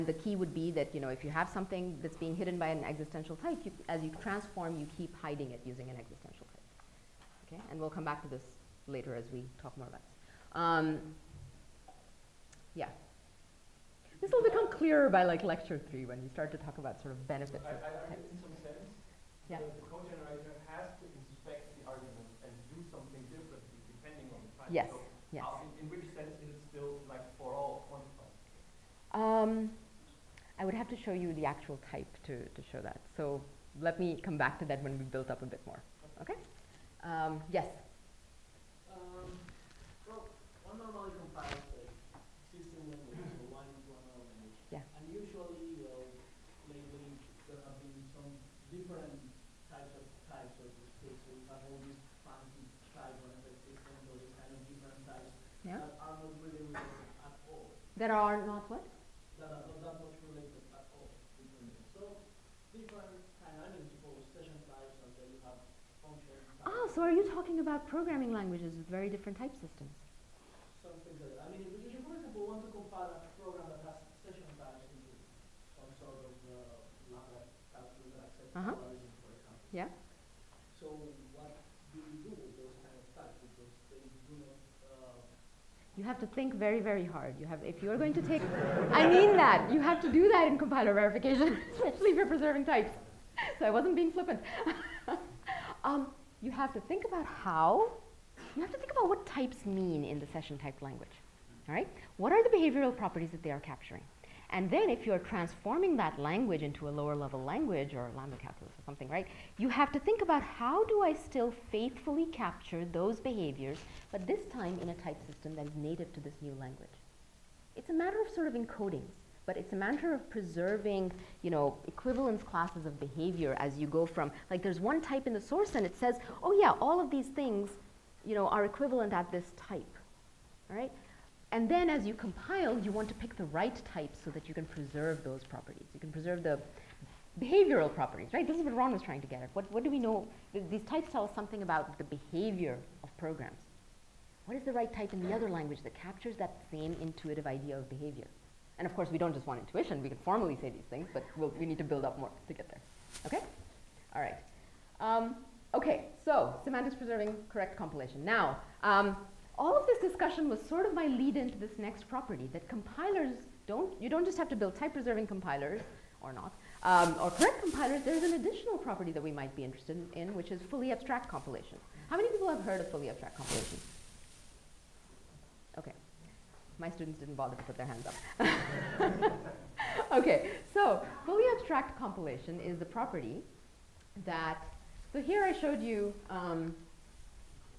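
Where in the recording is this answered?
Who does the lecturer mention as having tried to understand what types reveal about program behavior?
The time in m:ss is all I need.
2:18.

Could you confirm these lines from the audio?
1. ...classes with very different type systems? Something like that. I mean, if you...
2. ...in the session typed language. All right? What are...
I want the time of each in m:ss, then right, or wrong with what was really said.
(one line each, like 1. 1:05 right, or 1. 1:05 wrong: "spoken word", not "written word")
1. 1:08 wrong: "languages", not "classes"
2. 1:40 right.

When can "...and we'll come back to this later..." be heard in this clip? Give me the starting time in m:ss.
0:07.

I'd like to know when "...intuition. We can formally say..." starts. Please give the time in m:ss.
2:29.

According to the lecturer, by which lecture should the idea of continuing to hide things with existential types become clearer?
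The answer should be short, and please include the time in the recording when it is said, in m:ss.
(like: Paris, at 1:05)
Lecture three, at 0:15.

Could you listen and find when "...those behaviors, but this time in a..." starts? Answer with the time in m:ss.
1:52.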